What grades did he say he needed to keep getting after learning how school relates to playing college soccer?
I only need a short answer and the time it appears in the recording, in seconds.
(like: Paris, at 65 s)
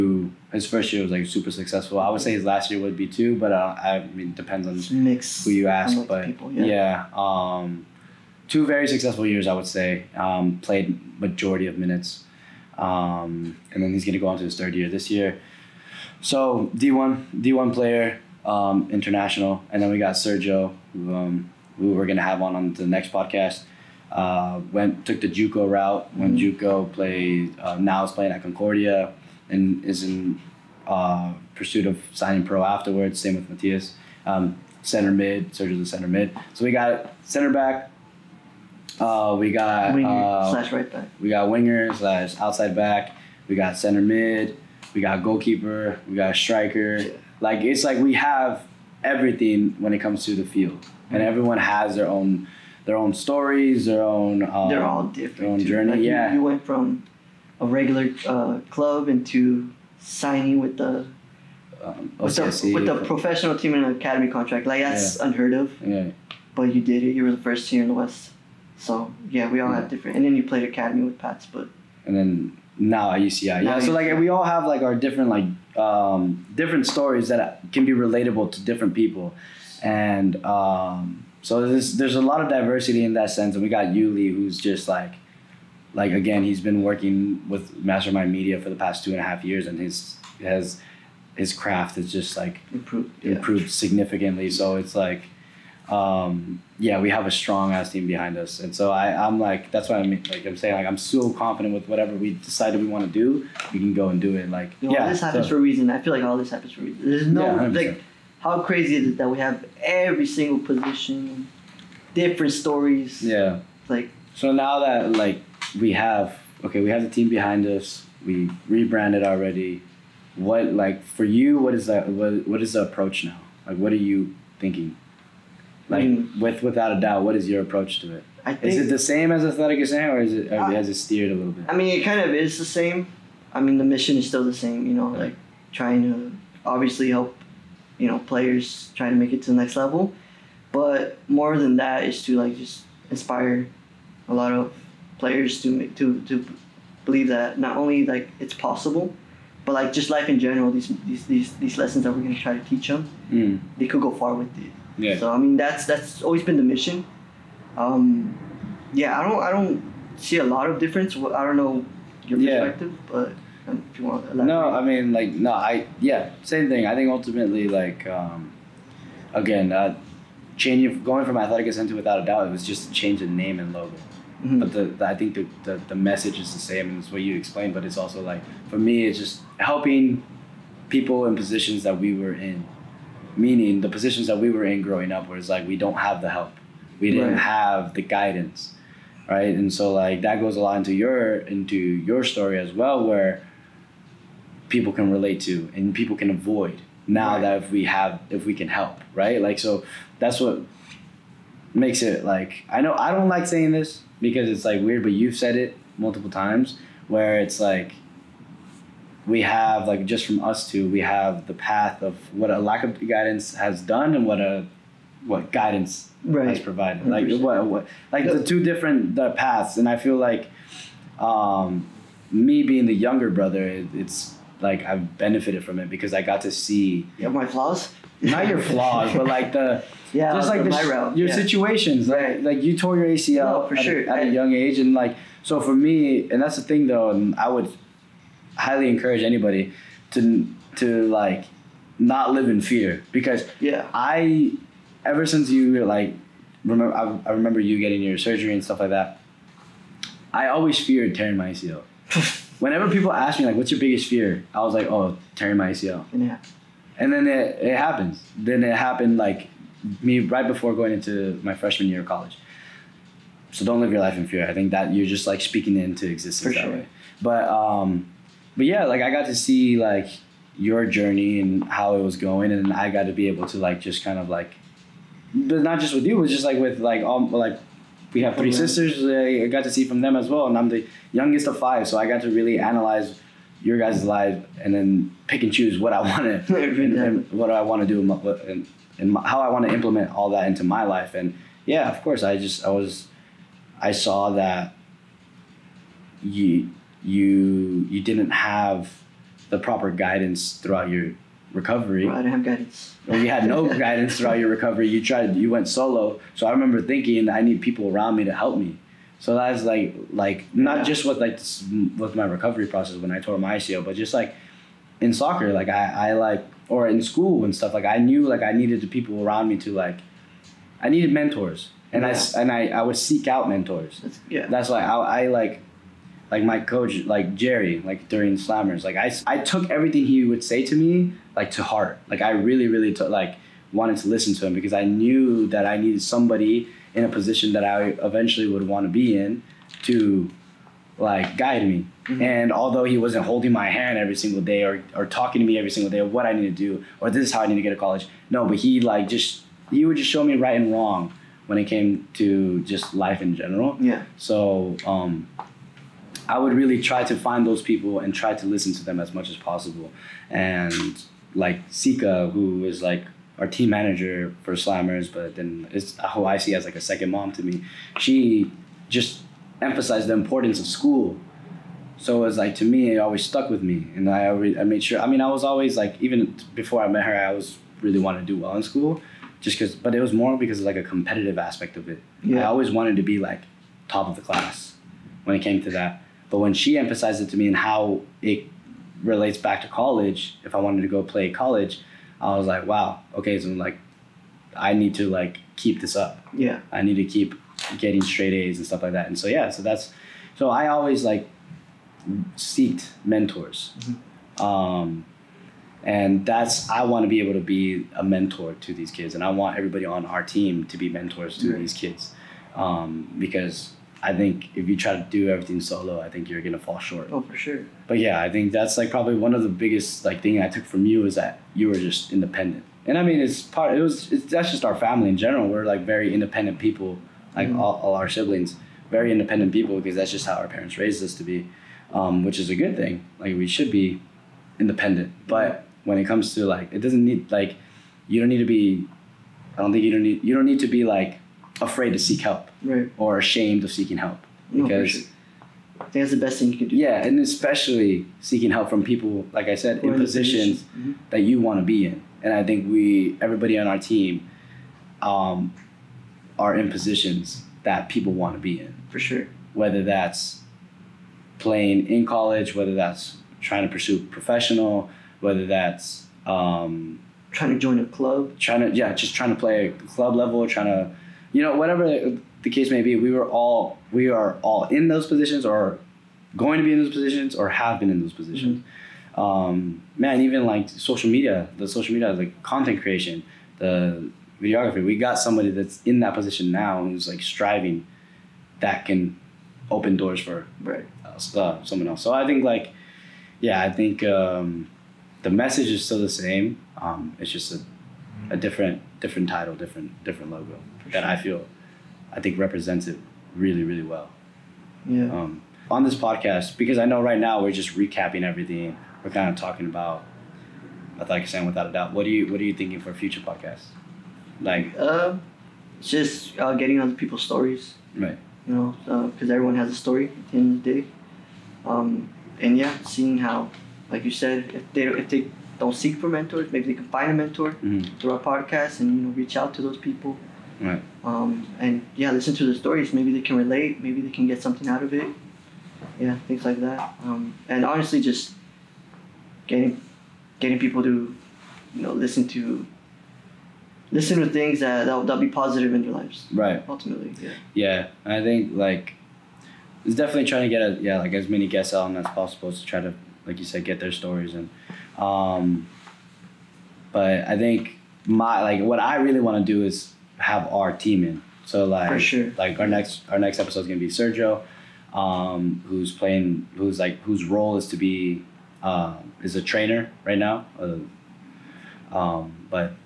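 Straight A's, at 398 s.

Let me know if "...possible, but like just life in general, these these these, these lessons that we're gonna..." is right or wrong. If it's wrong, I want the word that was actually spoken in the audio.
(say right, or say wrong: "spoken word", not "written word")
right.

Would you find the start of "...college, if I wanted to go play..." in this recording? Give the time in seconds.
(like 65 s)
389 s.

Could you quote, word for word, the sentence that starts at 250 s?
I always feared tearing my ACL.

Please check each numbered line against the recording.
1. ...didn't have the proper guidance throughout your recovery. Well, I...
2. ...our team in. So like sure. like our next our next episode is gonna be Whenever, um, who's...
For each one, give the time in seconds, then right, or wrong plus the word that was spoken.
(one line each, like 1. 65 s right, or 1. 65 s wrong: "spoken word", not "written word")
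1. 298 s right
2. 560 s wrong: "Sergio", not "Whenever".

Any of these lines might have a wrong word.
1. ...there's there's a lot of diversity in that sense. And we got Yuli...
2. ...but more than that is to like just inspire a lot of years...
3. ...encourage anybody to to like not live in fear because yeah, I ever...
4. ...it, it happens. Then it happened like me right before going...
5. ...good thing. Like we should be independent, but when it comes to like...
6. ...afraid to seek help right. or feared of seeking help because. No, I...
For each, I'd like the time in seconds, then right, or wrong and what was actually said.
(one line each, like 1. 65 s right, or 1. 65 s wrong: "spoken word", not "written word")
1. 81 s right
2. 140 s wrong: "players", not "years"
3. 238 s right
4. 257 s right
5. 432 s right
6. 441 s wrong: "ashamed", not "feared".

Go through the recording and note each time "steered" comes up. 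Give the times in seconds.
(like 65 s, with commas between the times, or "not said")
130 s.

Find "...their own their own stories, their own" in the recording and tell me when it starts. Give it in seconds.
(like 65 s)
51 s.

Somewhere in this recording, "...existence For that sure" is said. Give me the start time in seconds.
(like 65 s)
266 s.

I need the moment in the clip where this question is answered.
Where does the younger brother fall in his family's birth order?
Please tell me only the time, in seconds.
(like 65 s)
281 s.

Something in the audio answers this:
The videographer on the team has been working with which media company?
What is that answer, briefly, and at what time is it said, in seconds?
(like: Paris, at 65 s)
Mastermind Media, at 87 s.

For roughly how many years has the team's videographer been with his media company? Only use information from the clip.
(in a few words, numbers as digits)
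2.5 years.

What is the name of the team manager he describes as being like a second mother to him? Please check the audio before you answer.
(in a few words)
Sika.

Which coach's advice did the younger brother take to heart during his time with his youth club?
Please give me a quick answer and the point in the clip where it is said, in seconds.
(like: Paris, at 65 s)
Jerry, at 327 s.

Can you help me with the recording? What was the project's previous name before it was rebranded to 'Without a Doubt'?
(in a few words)
Athletic Ascent.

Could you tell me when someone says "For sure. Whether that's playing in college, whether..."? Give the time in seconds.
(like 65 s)
458 s.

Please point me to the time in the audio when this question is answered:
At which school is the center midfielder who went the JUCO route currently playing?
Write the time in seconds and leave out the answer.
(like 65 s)
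28 s.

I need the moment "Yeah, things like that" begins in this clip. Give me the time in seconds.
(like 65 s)
535 s.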